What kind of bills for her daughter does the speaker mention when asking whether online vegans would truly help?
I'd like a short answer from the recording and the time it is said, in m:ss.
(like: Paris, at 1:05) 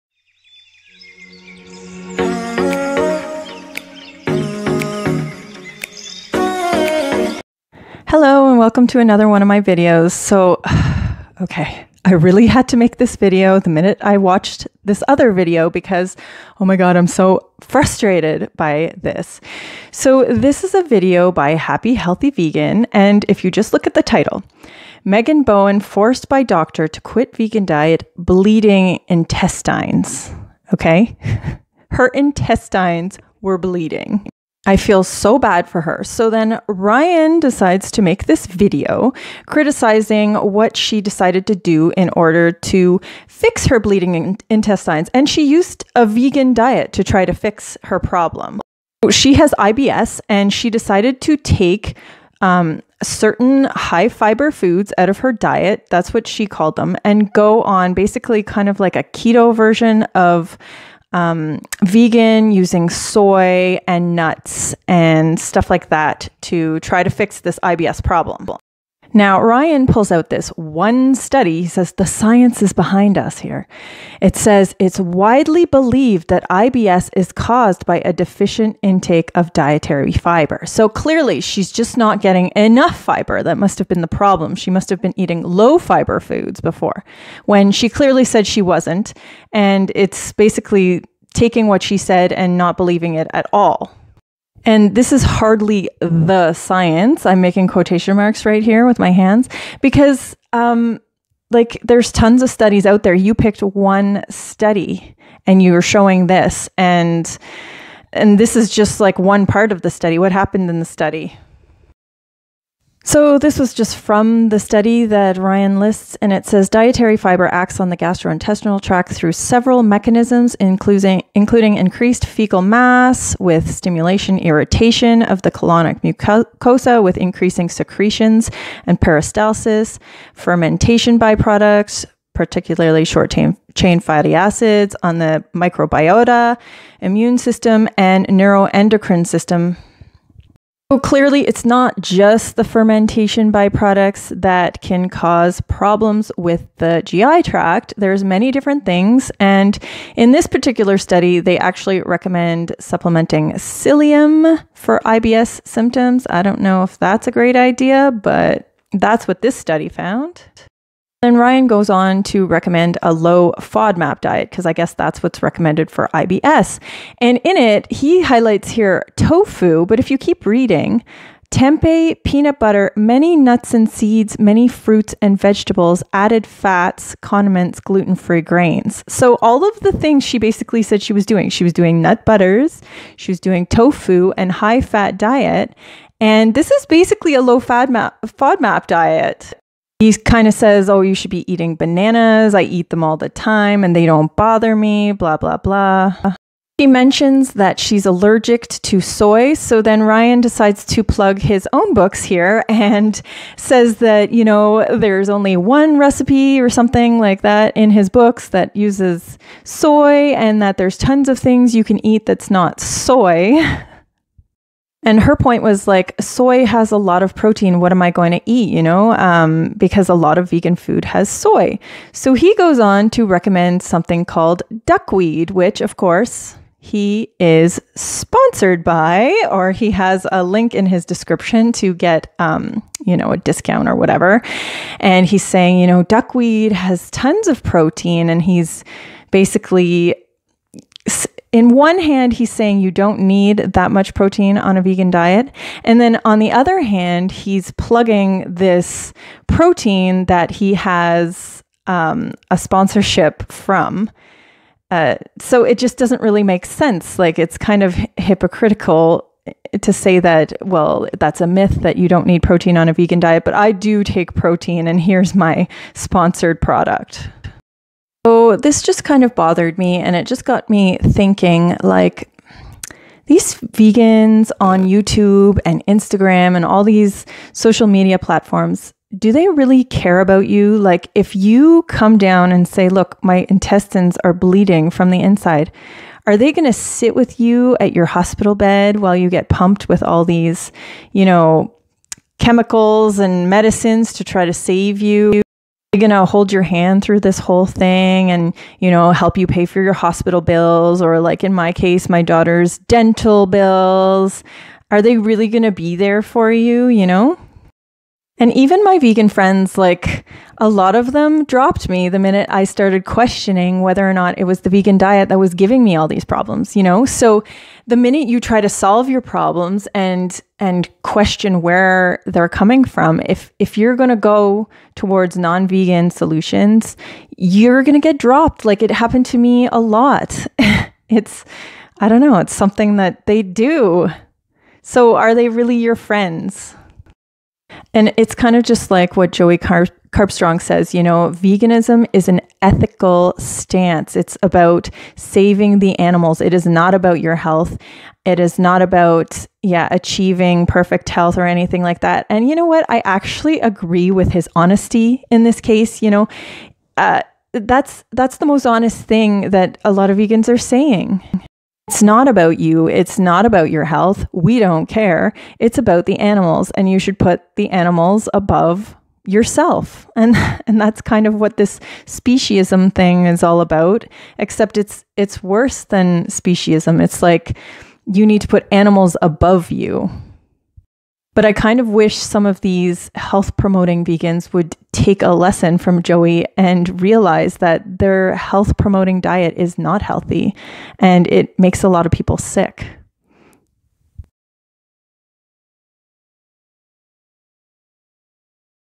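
dental bills, at 5:02.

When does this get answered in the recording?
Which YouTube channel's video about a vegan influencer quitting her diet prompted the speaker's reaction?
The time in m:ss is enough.
0:21.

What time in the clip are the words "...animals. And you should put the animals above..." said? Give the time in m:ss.
6:06.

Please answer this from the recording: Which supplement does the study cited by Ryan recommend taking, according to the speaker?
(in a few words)
psyllium.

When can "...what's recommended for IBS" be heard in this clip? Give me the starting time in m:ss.
2:45.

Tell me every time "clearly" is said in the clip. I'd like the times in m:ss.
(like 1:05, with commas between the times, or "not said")
1:20, 1:27, 2:20.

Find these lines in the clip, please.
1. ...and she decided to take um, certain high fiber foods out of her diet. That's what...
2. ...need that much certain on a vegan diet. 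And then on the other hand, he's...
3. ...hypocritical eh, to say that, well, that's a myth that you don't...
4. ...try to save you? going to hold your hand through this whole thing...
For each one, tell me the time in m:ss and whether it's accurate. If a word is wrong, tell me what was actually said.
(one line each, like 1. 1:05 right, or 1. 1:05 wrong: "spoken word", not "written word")
1. 0:50 right
2. 4:03 wrong: "protein", not "certain"
3. 4:18 right
4. 4:54 right.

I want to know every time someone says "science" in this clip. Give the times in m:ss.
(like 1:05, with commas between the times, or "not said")
1:12, 1:36.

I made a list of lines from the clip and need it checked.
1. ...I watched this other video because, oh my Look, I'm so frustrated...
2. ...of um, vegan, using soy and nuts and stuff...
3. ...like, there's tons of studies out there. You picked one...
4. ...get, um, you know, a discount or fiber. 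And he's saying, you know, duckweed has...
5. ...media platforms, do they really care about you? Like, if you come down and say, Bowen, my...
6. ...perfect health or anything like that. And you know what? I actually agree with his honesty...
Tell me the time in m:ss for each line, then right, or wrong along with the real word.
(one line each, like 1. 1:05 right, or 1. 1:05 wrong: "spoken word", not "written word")
1. 0:14 wrong: "God", not "Look"
2. 1:00 right
3. 1:41 right
4. 3:51 wrong: "whatever", not "fiber"
5. 4:37 wrong: "Look", not "Bowen"
6. 5:50 right.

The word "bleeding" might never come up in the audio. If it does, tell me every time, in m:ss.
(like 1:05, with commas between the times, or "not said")
0:28, 0:33, 0:43, 4:44.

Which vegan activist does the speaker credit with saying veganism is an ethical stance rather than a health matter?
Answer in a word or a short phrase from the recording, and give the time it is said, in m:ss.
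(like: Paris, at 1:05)
Joey Carbstrong, at 5:39.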